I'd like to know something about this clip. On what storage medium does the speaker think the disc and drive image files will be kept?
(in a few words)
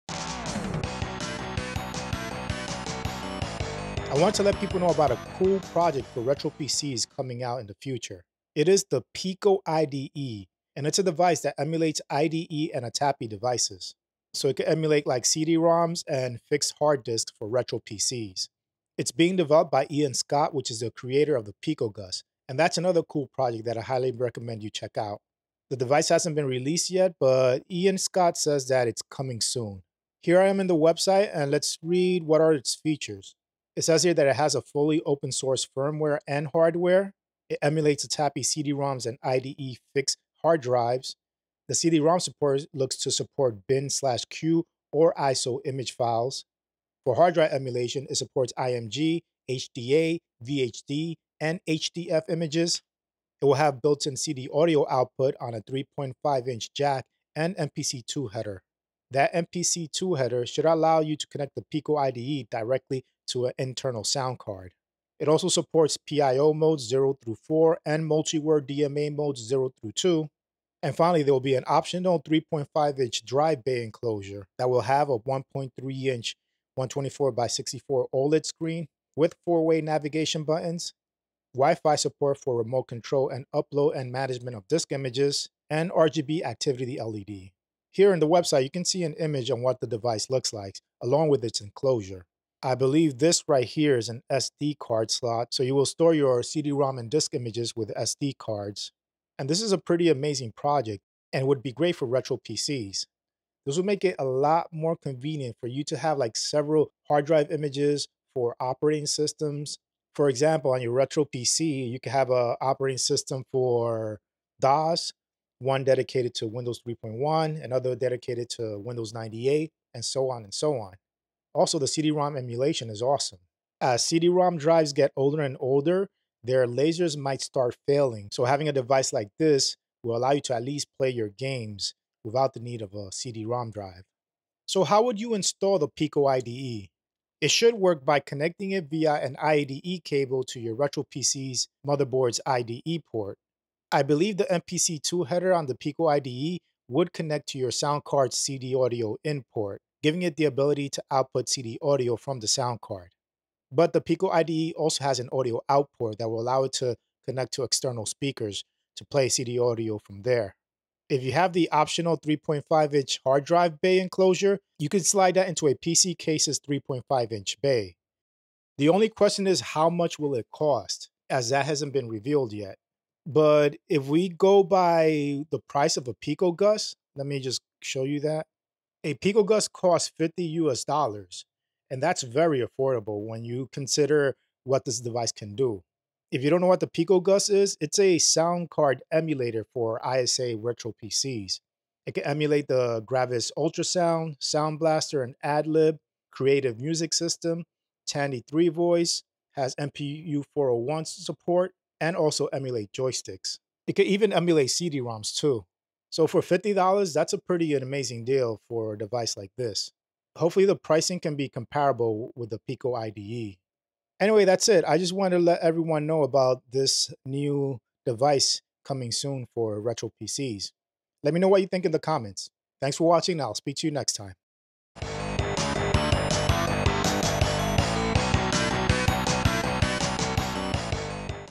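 SD cards.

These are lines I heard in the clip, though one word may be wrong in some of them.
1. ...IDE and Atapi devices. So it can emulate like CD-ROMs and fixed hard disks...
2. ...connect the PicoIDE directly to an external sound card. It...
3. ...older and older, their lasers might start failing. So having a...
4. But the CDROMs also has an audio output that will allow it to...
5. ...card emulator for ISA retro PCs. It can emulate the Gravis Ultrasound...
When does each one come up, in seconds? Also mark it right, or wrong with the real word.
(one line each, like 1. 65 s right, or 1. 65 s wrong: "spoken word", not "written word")
1. 12 s right
2. 61 s wrong: "internal", not "external"
3. 125 s right
4. 153 s wrong: "PicoIDE", not "CDROMs"
5. 188 s right.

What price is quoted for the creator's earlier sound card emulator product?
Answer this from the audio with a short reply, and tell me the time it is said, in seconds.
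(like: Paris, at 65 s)
$50, at 180 s.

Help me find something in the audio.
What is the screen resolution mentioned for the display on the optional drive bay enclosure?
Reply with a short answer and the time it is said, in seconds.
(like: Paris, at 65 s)
124 x 64, at 76 s.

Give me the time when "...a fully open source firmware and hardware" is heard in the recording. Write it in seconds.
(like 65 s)
34 s.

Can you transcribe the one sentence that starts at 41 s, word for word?
The CD-ROM support looks to support bin slash CUE or ISO image files.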